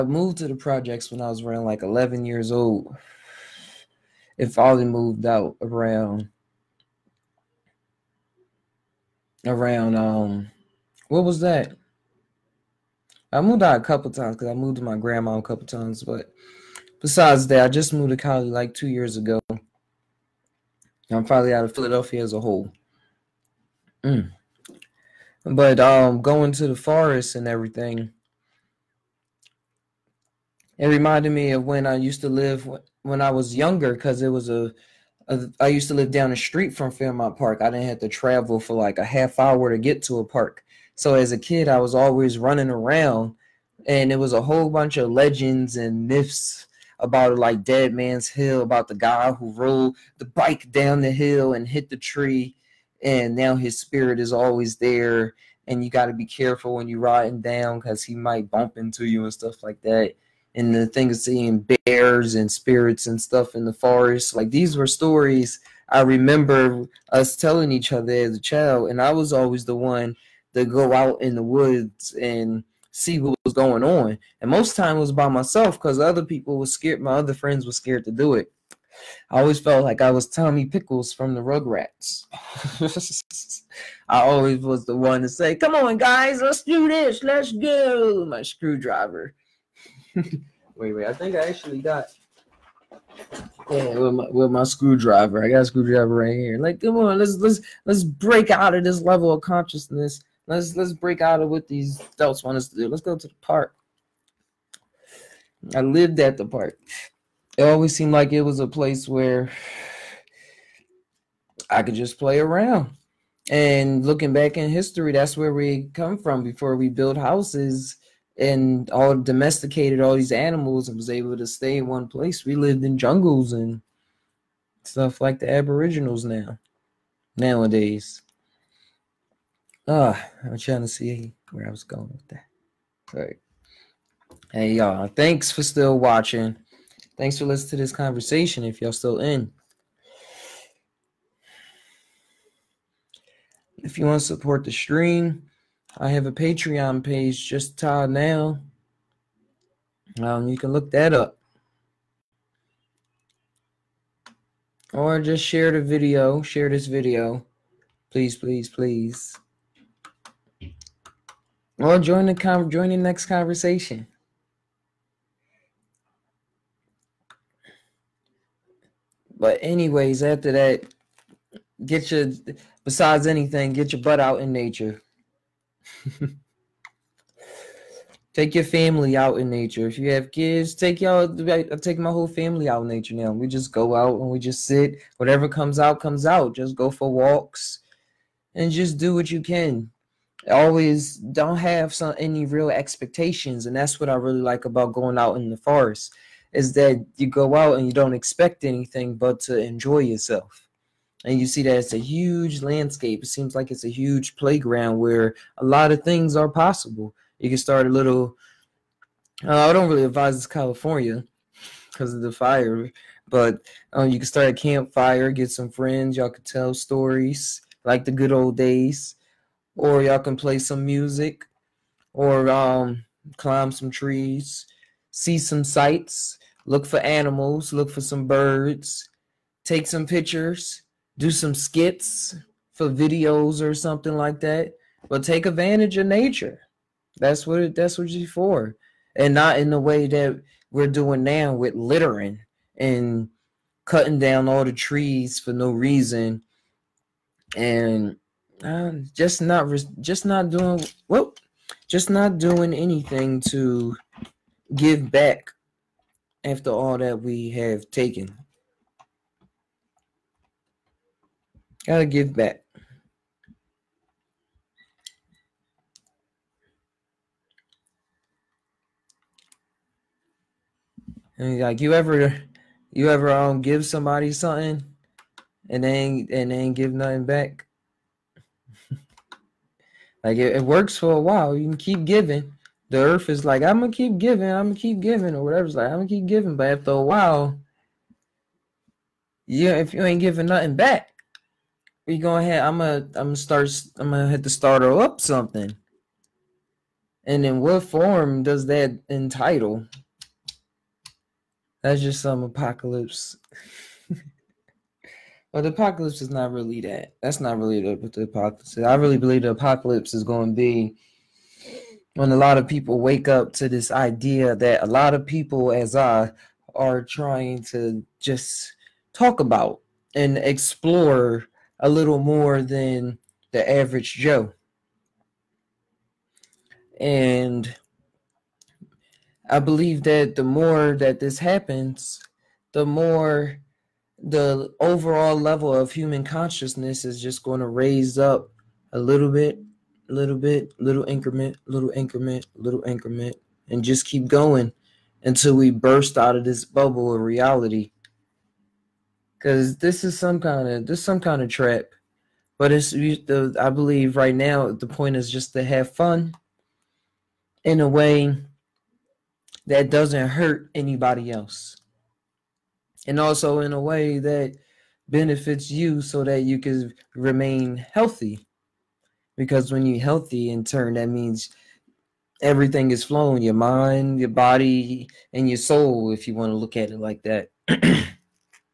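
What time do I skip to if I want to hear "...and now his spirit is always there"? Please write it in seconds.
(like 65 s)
53 s.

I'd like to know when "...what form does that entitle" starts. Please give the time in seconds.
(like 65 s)
297 s.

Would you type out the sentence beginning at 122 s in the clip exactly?
We lived in jungles and stuff like the aboriginals now nowadays uh, I'm trying to see where I was going with that.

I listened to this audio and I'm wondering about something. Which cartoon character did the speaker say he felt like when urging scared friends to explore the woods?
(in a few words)
Tommy Pickles.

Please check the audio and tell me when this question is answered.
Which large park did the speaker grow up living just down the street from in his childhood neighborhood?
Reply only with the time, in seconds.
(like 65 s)
36 s.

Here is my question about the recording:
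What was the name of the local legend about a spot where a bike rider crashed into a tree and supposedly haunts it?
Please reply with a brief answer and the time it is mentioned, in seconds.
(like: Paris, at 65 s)
Dead Man's Hill, at 47 s.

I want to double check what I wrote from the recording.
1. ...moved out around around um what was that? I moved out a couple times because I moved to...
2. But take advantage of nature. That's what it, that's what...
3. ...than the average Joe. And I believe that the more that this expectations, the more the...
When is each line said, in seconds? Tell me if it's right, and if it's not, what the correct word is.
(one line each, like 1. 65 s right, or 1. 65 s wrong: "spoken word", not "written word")
1. 4 s right
2. 235 s right
3. 322 s wrong: "happens", not "expectations".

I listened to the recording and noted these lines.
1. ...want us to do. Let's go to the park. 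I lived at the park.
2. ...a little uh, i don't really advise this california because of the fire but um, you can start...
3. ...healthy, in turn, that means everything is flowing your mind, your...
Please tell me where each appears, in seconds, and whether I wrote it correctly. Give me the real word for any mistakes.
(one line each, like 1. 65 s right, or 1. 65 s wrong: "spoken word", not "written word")
1. 102 s right
2. 207 s right
3. 370 s right.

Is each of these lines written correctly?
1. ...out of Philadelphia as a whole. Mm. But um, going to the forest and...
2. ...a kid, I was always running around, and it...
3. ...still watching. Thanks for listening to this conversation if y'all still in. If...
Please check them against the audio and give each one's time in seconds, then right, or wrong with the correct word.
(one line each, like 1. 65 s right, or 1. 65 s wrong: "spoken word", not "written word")
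1. 21 s right
2. 41 s right
3. 135 s right.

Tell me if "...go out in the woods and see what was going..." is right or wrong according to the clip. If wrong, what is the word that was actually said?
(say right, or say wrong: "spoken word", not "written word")
right.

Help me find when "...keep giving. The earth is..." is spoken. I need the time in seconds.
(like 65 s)
281 s.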